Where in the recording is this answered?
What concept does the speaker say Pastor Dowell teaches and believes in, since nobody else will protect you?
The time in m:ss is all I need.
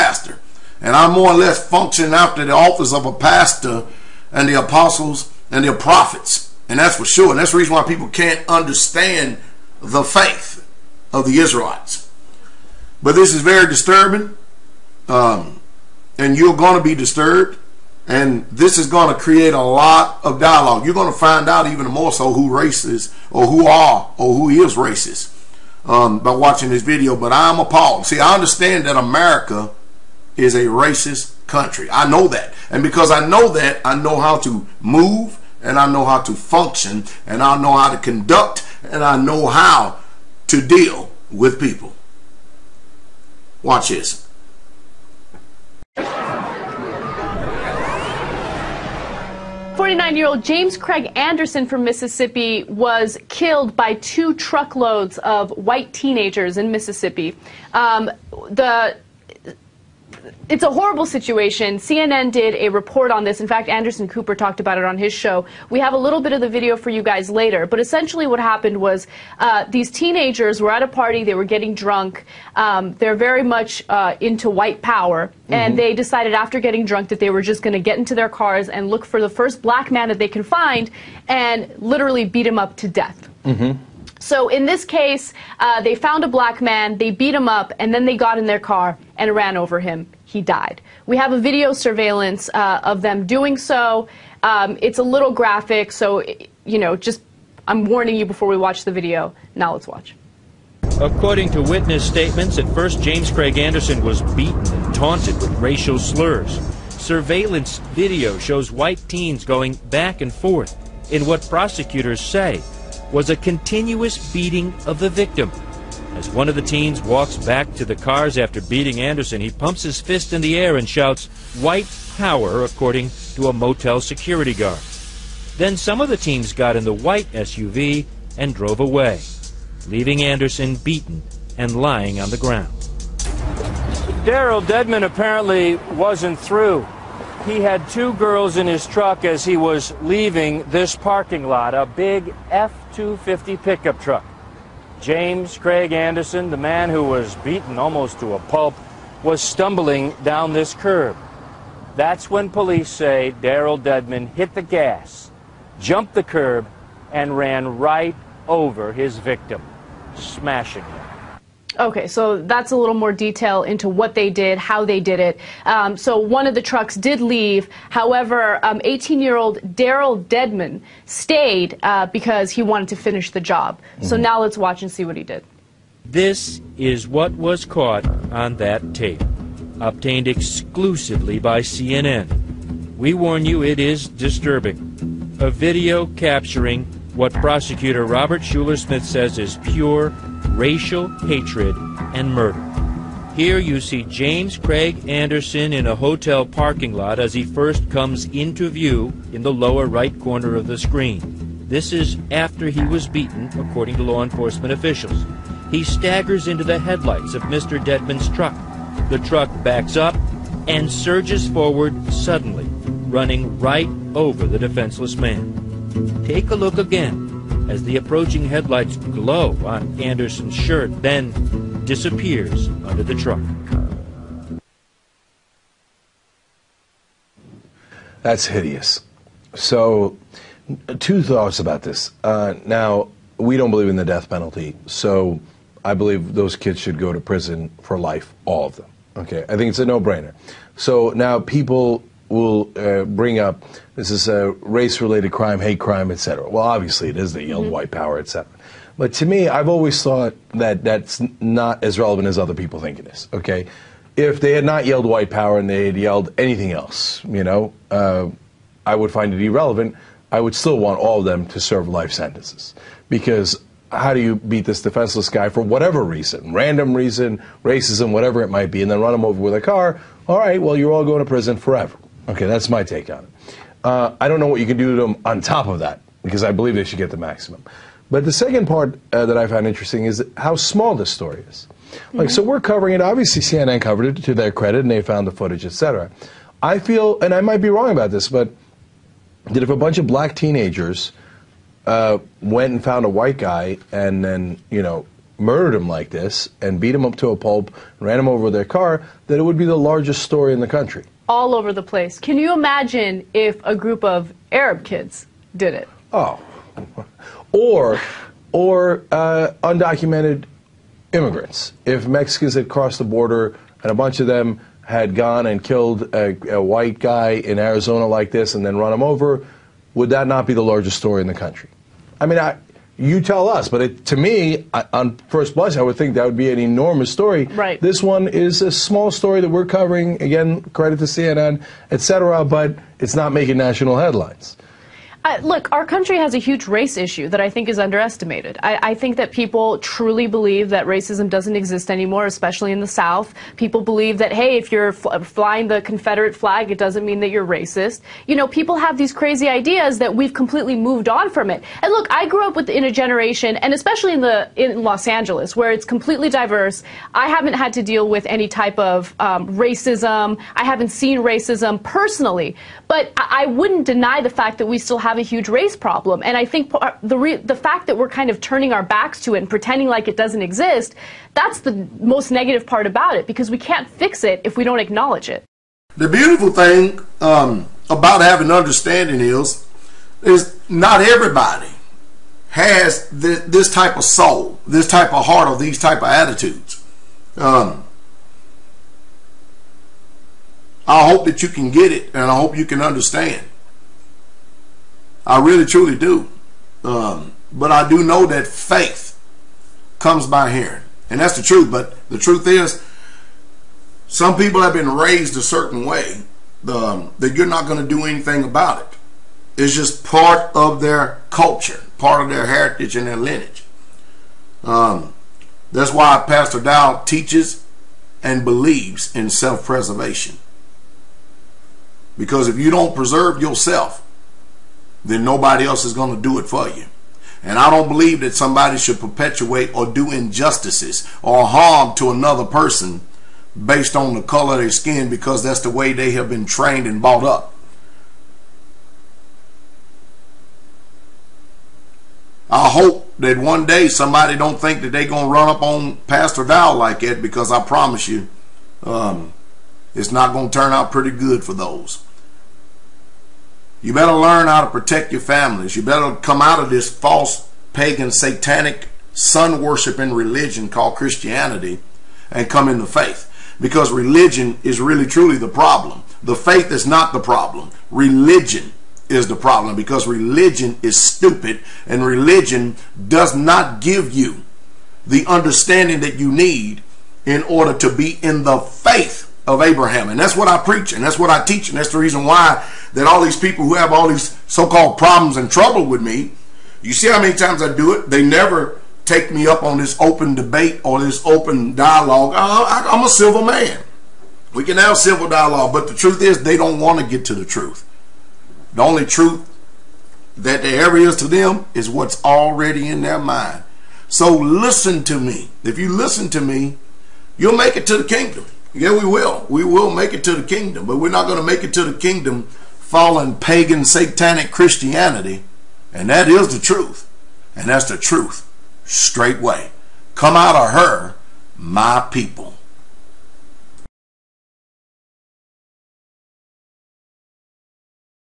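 6:59.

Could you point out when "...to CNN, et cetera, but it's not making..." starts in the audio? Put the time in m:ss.
5:30.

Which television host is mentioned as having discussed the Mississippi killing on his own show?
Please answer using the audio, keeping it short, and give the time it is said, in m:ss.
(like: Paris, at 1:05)
Anderson Cooper, at 1:03.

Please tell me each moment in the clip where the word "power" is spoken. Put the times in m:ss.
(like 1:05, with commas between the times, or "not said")
1:14, 2:02, 4:07, 4:15.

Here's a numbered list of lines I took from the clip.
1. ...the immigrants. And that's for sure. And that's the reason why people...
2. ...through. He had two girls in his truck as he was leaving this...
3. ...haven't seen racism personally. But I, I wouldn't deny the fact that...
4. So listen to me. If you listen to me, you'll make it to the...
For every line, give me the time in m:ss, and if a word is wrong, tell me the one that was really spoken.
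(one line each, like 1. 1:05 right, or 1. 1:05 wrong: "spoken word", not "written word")
1. 0:05 wrong: "prophets", not "immigrants"
2. 2:16 right
3. 6:00 right
4. 8:24 right.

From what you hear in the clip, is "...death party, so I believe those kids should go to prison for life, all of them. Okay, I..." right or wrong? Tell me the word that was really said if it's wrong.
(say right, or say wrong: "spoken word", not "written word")
wrong: "penalty", not "party".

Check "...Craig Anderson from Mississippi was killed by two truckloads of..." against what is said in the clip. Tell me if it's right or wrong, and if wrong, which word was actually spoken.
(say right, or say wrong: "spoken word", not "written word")
right.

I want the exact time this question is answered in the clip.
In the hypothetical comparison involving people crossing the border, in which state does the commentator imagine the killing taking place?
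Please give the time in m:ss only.
5:17.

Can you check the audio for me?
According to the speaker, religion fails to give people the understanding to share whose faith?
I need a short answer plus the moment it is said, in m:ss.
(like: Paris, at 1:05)
Abraham, at 7:59.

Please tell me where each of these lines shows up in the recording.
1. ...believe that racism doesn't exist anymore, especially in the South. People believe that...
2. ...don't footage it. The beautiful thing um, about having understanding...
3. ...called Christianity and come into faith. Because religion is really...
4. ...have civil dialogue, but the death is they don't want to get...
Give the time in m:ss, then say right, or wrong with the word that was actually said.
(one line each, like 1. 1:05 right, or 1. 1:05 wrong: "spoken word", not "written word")
1. 5:40 right
2. 6:14 wrong: "acknowledge", not "footage"
3. 7:40 right
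4. 8:14 wrong: "truth", not "death".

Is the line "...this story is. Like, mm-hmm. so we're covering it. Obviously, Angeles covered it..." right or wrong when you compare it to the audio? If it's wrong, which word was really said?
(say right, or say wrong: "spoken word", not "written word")
wrong: "CNN", not "Angeles".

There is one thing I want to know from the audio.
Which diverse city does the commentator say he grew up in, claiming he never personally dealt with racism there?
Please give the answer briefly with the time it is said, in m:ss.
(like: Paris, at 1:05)
Los Angeles, at 5:54.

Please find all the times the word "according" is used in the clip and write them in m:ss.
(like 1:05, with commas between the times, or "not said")
1:40, 2:02, 3:23.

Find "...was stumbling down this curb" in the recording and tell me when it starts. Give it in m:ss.
2:29.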